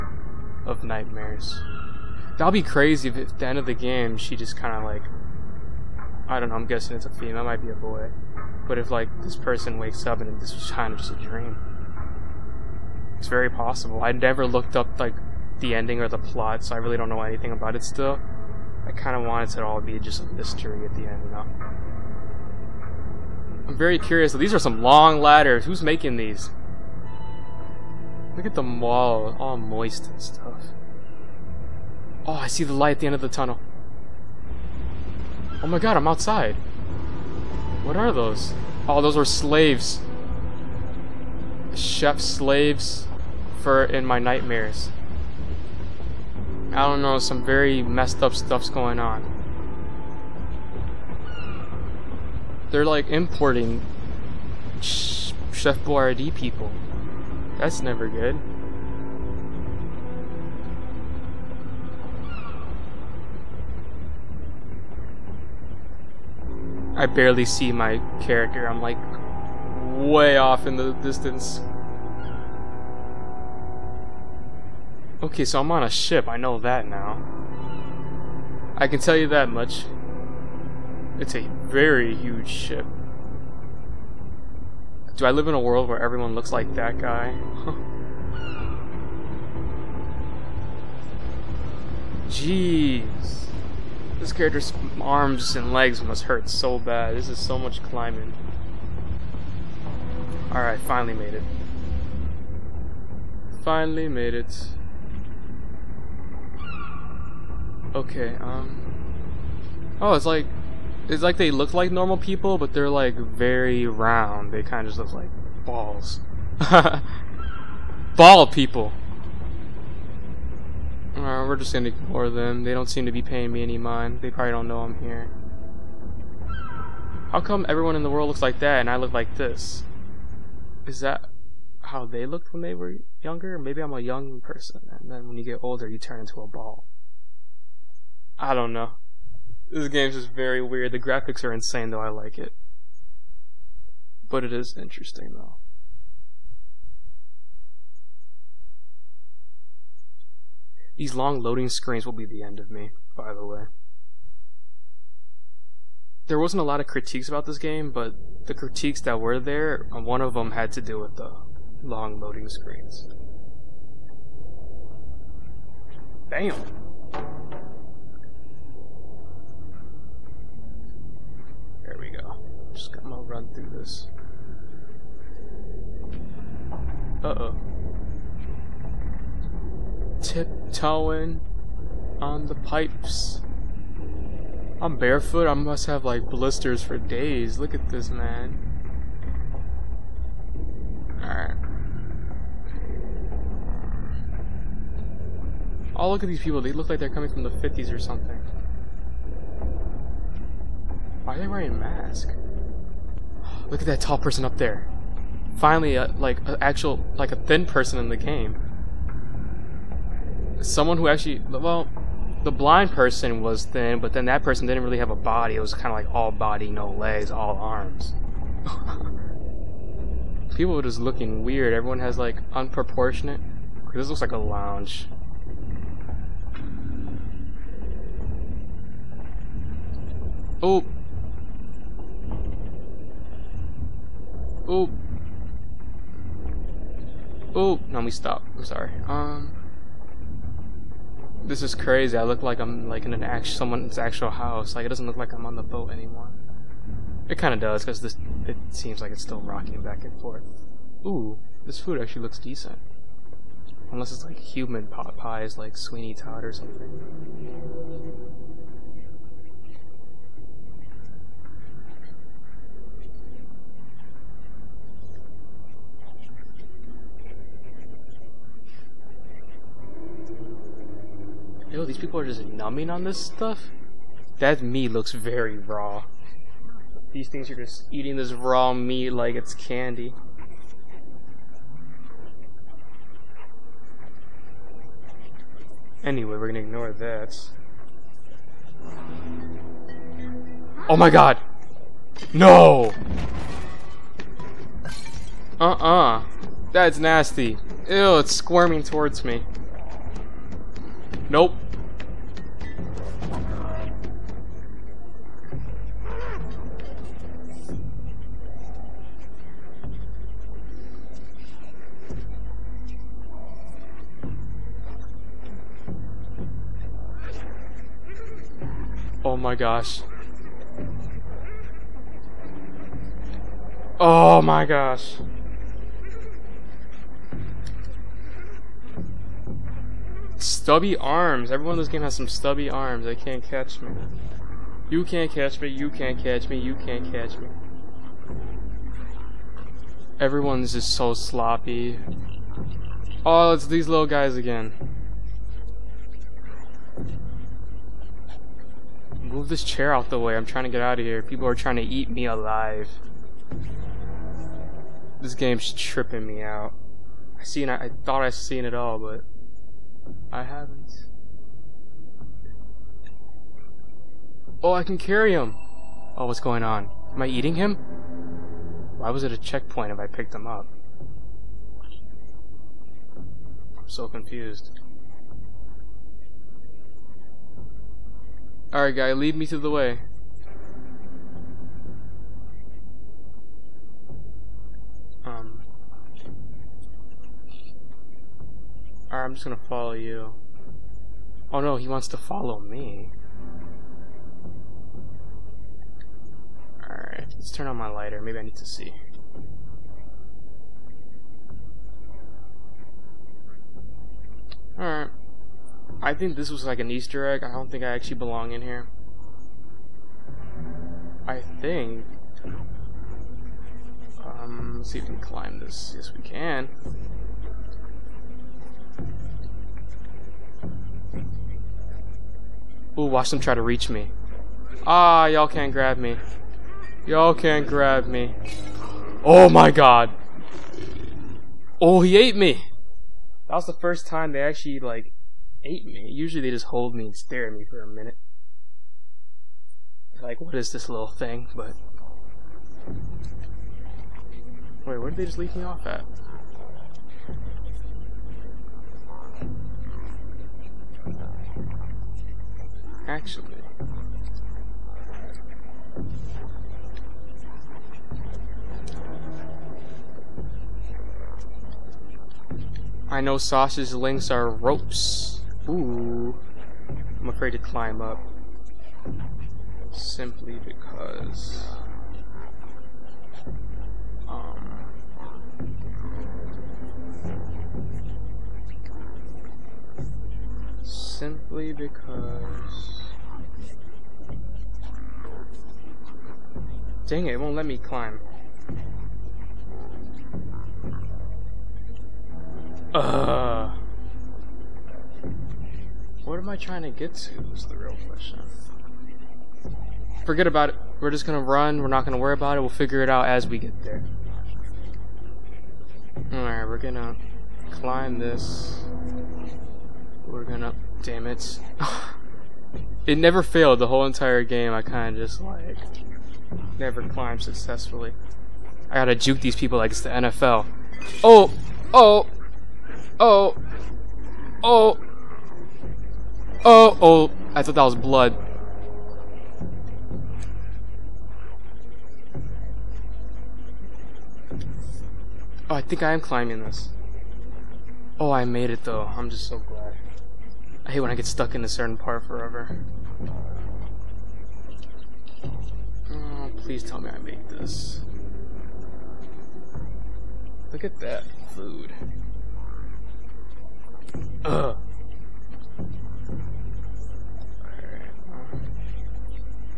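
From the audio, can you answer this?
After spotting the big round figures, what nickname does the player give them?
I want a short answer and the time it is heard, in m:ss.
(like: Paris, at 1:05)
Ball people, at 1:58.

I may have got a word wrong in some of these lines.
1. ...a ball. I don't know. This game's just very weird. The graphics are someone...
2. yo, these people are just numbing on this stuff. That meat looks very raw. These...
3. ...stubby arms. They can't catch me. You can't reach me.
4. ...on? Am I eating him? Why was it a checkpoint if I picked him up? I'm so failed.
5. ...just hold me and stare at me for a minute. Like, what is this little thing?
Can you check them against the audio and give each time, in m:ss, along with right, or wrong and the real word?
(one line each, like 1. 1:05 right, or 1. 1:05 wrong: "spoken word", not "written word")
1. 2:16 wrong: "insane", not "someone"
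2. 4:31 right
3. 5:32 wrong: "catch", not "reach"
4. 6:06 wrong: "confused", not "failed"
5. 7:16 right.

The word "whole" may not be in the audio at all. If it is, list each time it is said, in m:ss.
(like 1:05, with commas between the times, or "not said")
8:33.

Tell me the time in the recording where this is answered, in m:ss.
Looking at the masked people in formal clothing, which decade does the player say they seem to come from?
3:17.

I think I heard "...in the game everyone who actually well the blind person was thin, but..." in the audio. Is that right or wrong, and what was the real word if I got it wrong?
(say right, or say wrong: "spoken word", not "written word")
wrong: "someone", not "everyone".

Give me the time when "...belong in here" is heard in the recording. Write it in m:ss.
6:48.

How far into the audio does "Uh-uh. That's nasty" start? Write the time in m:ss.
4:55.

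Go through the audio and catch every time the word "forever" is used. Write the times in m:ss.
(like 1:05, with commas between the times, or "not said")
9:02.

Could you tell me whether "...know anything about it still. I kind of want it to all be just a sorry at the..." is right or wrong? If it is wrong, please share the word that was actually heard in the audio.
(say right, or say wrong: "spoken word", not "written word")
wrong: "mystery", not "sorry".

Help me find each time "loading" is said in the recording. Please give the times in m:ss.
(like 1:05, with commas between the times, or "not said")
2:31, 2:42.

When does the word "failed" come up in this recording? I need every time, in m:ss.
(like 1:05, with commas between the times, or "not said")
8:33.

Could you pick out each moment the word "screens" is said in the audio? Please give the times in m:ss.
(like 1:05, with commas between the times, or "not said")
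2:31, 2:42.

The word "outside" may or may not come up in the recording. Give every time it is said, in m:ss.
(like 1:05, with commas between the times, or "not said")
0:36.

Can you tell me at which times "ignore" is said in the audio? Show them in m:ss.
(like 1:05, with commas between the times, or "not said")
2:01, 4:46.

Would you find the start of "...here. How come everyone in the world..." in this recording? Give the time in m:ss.
2:04.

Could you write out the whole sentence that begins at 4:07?
It kind of does because this it seems like it's still rocking back and forth.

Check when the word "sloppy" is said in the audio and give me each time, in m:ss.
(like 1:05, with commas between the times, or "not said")
5:41.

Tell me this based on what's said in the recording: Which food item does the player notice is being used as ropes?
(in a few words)
Sausage links.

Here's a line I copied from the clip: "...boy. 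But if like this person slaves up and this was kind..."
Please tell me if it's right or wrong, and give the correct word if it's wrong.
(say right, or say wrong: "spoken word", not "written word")
wrong: "wakes", not "slaves".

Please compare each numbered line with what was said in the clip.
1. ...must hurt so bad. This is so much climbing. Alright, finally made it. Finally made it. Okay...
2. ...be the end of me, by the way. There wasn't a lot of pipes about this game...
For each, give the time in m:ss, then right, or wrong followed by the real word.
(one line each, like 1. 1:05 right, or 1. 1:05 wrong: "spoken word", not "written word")
1. 1:36 right
2. 2:32 wrong: "critiques", not "pipes".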